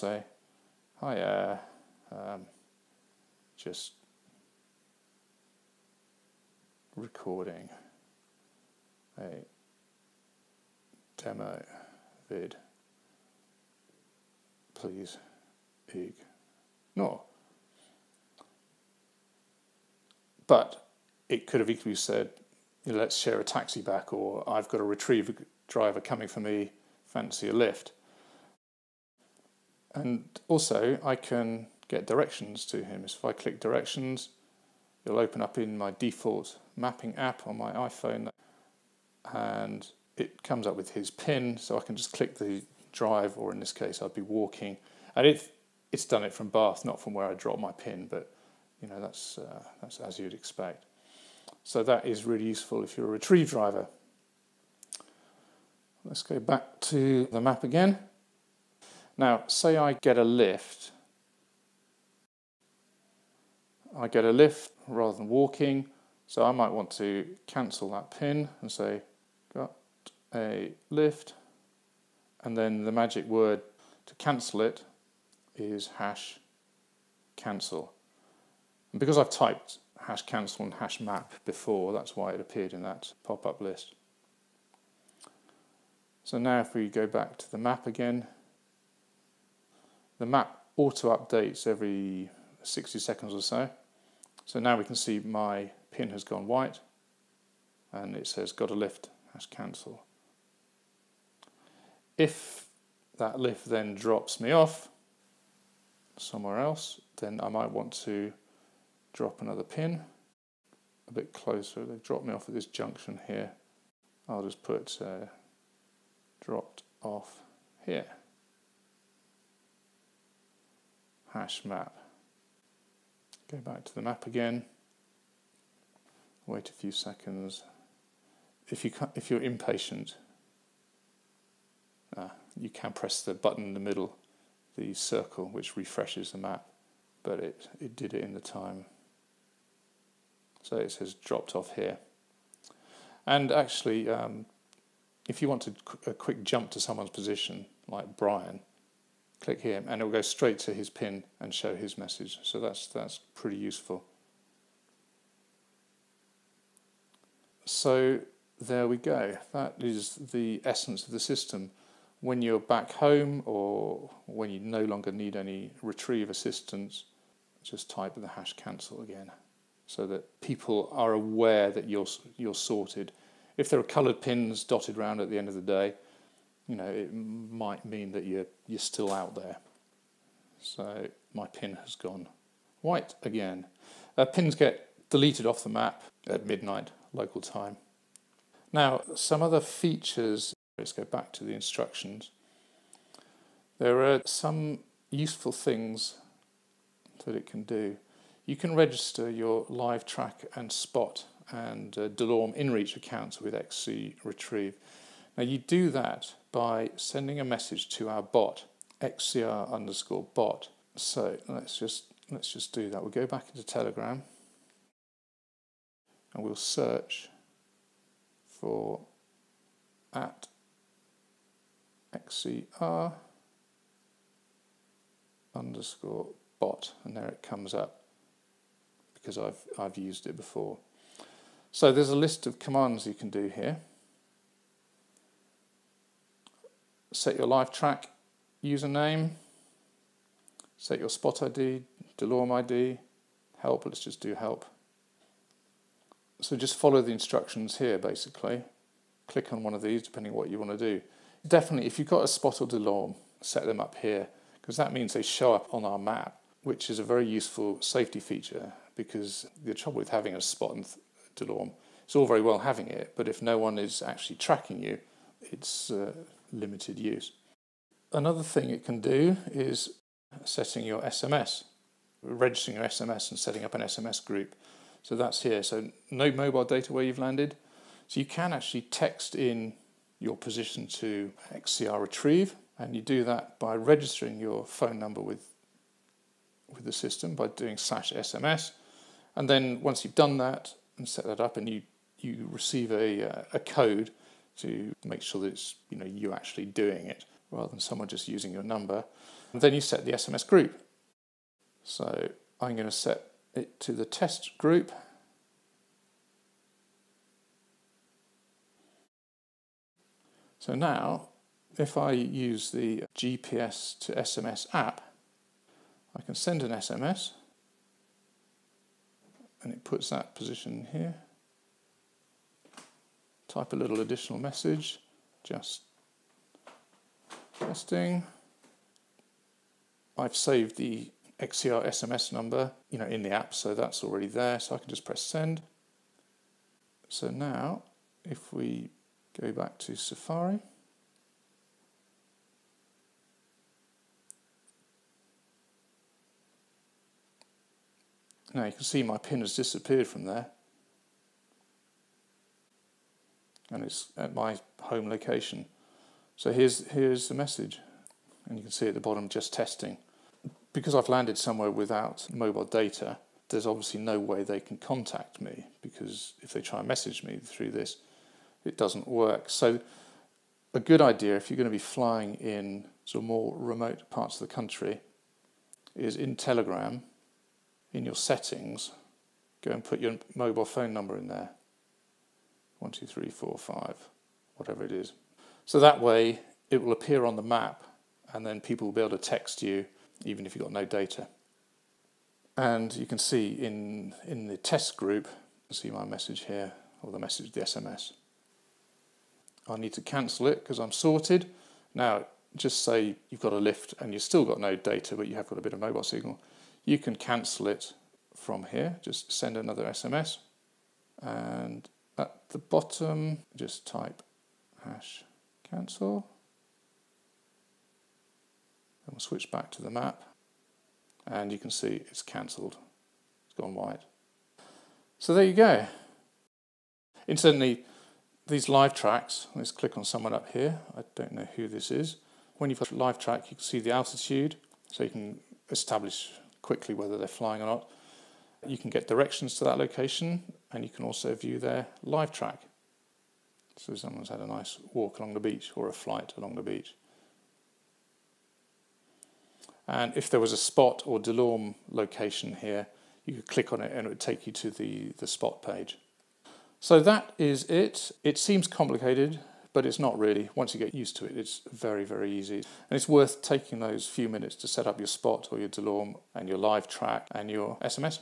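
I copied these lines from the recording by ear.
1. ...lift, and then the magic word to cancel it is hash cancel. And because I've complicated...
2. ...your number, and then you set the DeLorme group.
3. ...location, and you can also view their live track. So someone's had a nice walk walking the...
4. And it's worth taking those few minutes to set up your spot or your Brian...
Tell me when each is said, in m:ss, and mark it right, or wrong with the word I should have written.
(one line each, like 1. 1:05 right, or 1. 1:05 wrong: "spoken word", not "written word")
1. 1:10 wrong: "typed", not "complicated"
2. 4:58 wrong: "SMS", not "DeLorme"
3. 7:19 wrong: "along", not "walking"
4. 7:42 wrong: "DeLorme", not "Brian".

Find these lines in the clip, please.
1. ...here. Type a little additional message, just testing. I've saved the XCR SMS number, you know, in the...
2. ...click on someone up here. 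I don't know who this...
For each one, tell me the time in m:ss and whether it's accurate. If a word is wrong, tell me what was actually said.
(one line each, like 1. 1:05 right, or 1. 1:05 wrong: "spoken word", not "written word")
1. 5:20 right
2. 7:09 right.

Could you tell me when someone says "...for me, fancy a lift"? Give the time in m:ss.
0:26.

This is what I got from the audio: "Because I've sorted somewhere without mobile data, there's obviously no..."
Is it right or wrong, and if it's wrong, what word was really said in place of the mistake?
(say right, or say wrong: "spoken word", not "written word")
wrong: "landed", not "sorted".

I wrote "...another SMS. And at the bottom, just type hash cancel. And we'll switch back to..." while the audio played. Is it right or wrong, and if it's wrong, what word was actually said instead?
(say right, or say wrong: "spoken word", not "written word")
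right.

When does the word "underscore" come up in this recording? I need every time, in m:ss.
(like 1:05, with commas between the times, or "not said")
3:29, 3:45.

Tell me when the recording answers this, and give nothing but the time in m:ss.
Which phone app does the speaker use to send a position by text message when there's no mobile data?
5:13.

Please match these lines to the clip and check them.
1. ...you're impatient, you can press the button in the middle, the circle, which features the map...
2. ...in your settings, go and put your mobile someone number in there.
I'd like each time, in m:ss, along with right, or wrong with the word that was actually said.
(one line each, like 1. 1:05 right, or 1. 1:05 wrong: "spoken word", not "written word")
1. 2:09 wrong: "refreshes", not "features"
2. 6:17 wrong: "phone", not "someone".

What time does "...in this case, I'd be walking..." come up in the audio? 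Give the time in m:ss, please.
0:43.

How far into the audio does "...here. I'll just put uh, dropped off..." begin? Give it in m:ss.
1:53.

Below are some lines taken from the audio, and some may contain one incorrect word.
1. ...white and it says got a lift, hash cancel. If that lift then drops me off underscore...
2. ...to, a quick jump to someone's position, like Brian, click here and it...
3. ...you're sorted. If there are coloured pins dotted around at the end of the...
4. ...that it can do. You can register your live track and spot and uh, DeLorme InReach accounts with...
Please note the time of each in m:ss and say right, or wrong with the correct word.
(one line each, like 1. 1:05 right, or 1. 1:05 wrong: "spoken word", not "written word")
1. 1:36 wrong: "somewhere", not "underscore"
2. 2:25 right
3. 2:52 right
4. 3:17 right.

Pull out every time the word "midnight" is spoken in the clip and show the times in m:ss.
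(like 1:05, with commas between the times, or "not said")
3:06.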